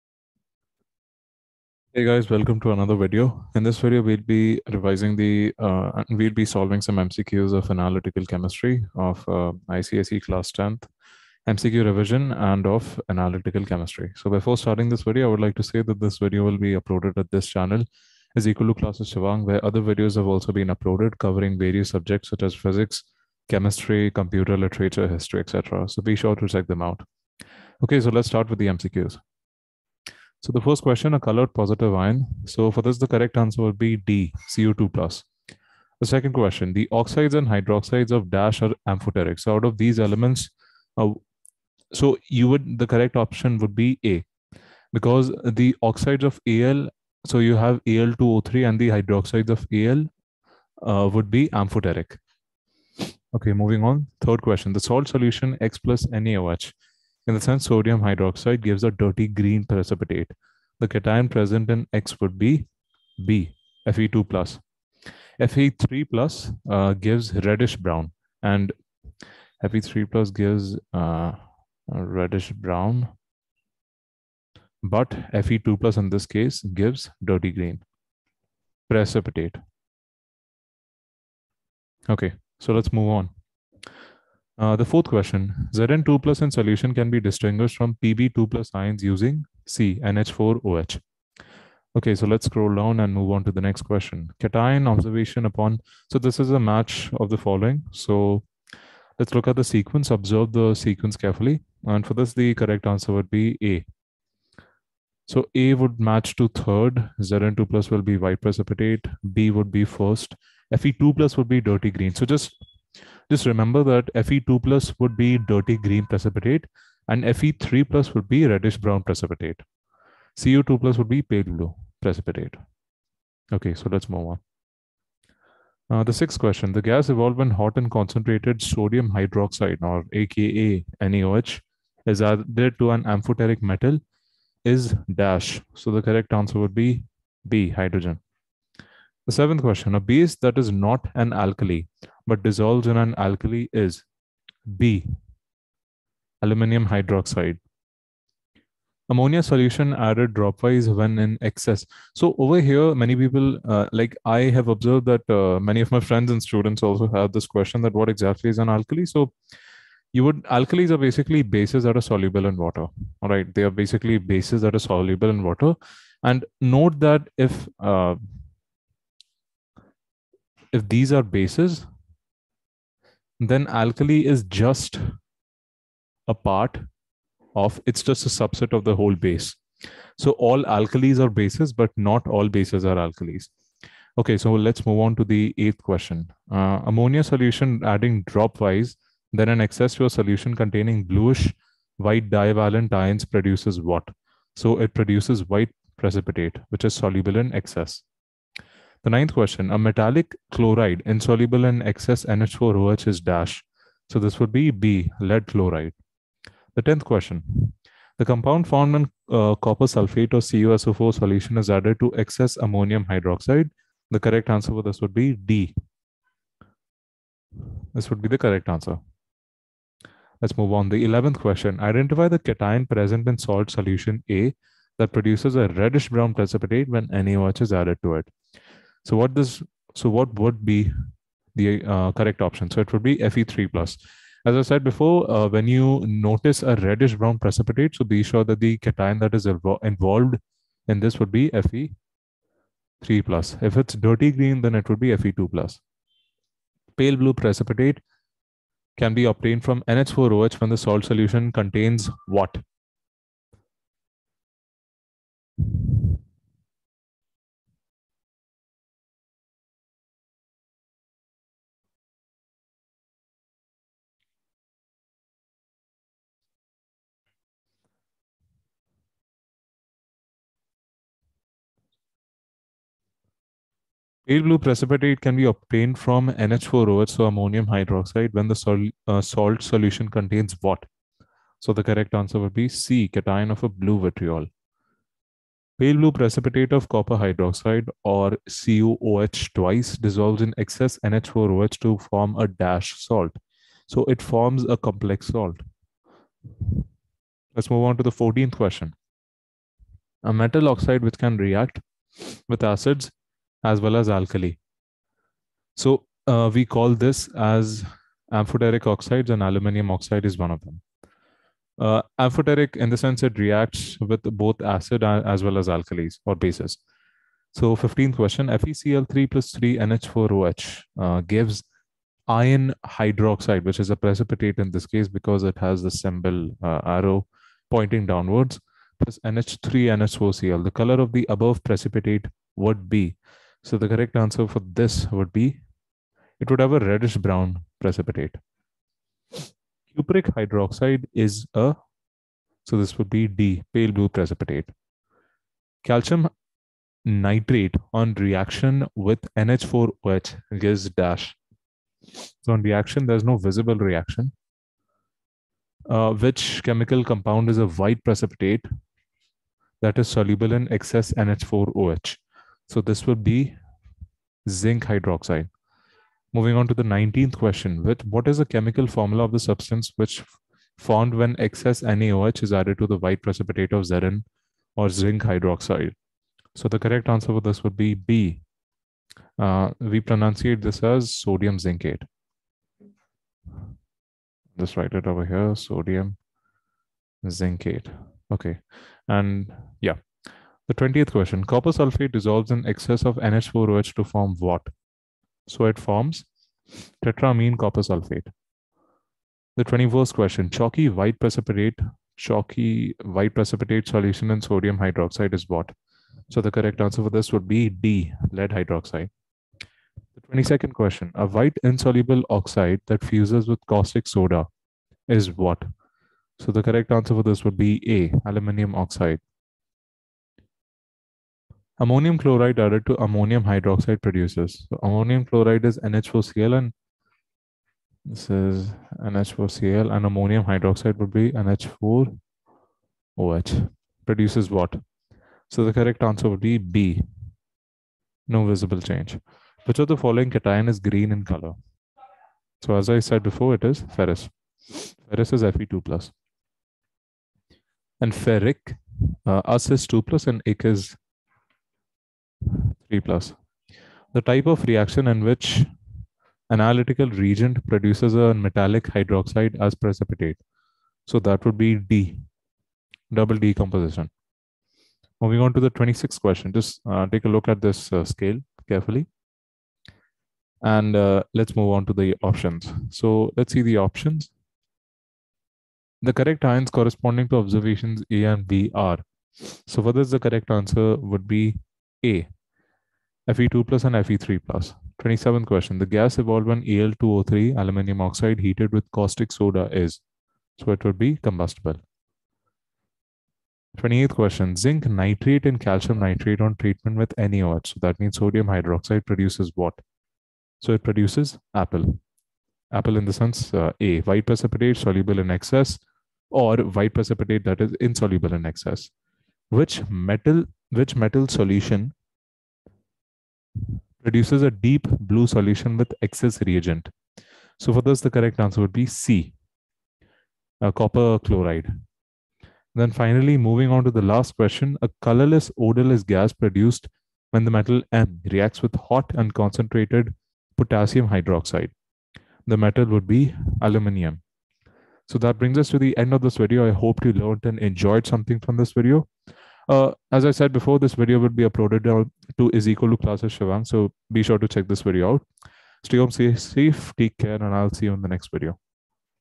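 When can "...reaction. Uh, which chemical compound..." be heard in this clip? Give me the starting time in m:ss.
5:53.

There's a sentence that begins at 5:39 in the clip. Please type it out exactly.
Cupric hydroxide is a, so this would be D, pale blue precipitate.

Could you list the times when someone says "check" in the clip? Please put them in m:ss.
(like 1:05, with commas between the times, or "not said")
0:26, 9:04.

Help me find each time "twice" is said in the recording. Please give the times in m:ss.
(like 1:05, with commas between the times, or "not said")
4:49.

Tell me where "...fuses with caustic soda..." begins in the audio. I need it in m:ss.
6:53.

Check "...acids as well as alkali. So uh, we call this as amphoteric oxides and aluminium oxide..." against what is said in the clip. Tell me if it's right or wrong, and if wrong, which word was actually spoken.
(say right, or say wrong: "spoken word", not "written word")
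right.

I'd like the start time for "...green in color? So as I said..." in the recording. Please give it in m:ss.
7:20.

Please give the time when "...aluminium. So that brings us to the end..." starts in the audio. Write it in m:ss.
8:53.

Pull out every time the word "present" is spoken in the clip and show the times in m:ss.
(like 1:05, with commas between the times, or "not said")
1:01, 3:42.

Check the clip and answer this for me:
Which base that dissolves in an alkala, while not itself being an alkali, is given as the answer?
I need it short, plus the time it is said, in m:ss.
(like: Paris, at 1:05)
Aluminium hydroxide, at 2:26.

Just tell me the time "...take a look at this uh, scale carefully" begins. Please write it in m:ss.
7:47.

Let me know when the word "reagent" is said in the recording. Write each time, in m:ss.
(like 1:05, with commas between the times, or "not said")
7:37, 8:36.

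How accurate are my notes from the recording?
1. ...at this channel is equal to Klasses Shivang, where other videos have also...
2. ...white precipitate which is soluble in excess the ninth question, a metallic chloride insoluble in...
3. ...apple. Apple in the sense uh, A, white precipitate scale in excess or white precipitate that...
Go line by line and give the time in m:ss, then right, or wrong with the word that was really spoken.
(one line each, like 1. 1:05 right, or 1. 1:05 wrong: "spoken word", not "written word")
1. 0:17 right
2. 3:15 right
3. 8:21 wrong: "soluble", not "scale".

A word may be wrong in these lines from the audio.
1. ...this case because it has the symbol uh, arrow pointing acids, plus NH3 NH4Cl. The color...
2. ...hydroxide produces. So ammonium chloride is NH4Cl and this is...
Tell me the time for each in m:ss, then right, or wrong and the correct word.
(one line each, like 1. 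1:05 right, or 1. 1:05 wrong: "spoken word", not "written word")
1. 5:24 wrong: "downwards", not "acids"
2. 7:03 right.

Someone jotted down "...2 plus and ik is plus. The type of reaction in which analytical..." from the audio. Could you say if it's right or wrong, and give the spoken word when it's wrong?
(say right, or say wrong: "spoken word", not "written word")
right.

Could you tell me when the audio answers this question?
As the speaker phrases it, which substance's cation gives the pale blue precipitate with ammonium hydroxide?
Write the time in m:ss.
4:43.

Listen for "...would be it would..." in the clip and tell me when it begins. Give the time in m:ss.
5:35.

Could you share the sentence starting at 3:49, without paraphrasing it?
So what does so what would be the uh, correct option?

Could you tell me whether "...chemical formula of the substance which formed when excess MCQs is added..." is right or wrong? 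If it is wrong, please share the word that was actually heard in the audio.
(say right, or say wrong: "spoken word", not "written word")
wrong: "NaOH", not "MCQs".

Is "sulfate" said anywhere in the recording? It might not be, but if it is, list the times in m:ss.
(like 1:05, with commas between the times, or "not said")
3:29, 6:31, 6:37.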